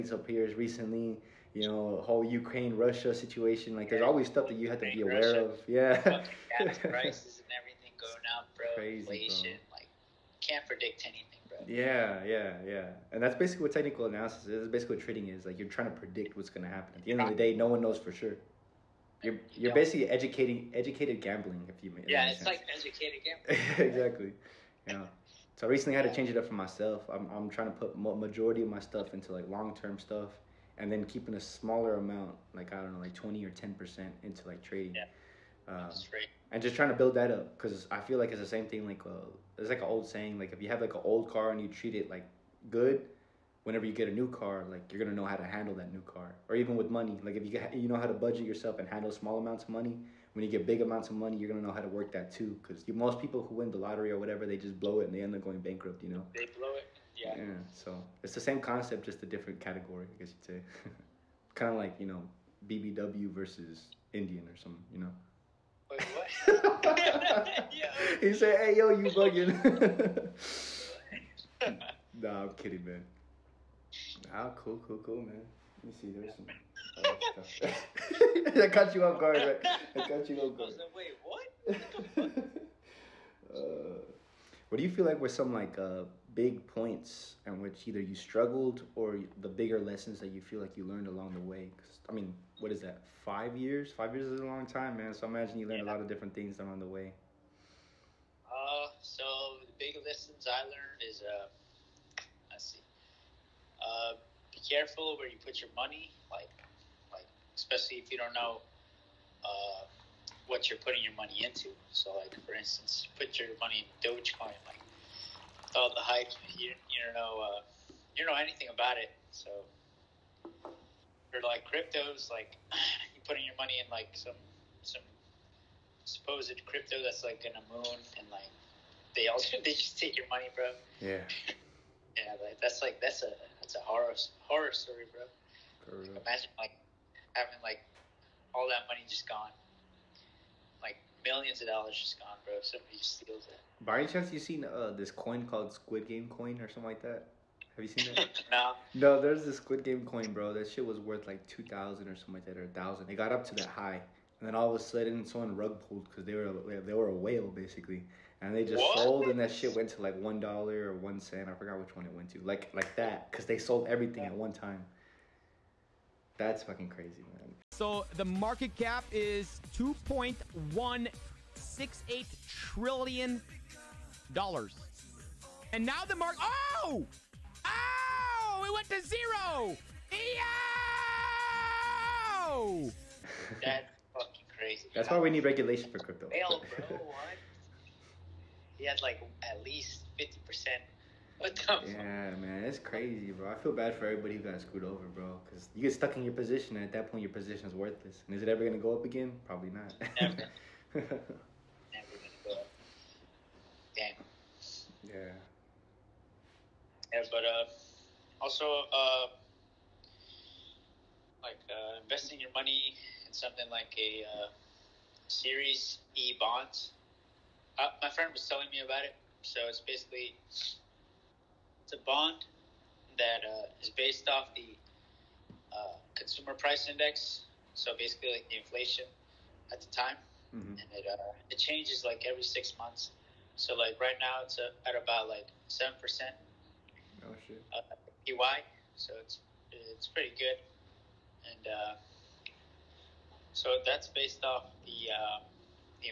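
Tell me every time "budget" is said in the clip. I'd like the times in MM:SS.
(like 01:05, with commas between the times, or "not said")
00:48.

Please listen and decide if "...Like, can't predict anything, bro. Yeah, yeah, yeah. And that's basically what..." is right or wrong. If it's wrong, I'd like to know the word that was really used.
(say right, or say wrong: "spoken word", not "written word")
right.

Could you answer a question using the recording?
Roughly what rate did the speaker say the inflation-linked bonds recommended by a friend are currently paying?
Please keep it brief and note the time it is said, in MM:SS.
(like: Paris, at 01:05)
7 percent, at 03:55.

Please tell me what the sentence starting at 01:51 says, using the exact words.
So, like for instance, put your money in Dogecoin, like all the hype.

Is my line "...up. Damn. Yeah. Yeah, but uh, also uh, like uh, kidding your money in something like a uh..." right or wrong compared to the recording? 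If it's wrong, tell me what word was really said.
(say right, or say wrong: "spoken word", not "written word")
wrong: "investing", not "kidding".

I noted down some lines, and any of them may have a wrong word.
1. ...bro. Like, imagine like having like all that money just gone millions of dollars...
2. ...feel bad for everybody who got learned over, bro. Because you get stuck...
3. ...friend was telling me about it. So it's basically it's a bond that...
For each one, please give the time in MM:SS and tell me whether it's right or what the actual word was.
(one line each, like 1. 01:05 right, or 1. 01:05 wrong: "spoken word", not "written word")
1. 02:15 right
2. 03:13 wrong: "screwed", not "learned"
3. 03:38 right.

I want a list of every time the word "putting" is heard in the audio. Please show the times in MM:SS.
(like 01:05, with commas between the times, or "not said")
01:50, 02:03.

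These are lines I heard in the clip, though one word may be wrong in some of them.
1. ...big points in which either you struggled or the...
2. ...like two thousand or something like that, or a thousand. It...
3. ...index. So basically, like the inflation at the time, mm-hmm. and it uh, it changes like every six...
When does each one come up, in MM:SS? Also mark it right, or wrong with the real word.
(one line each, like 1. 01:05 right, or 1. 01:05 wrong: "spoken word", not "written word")
1. 01:26 right
2. 02:31 right
3. 03:46 right.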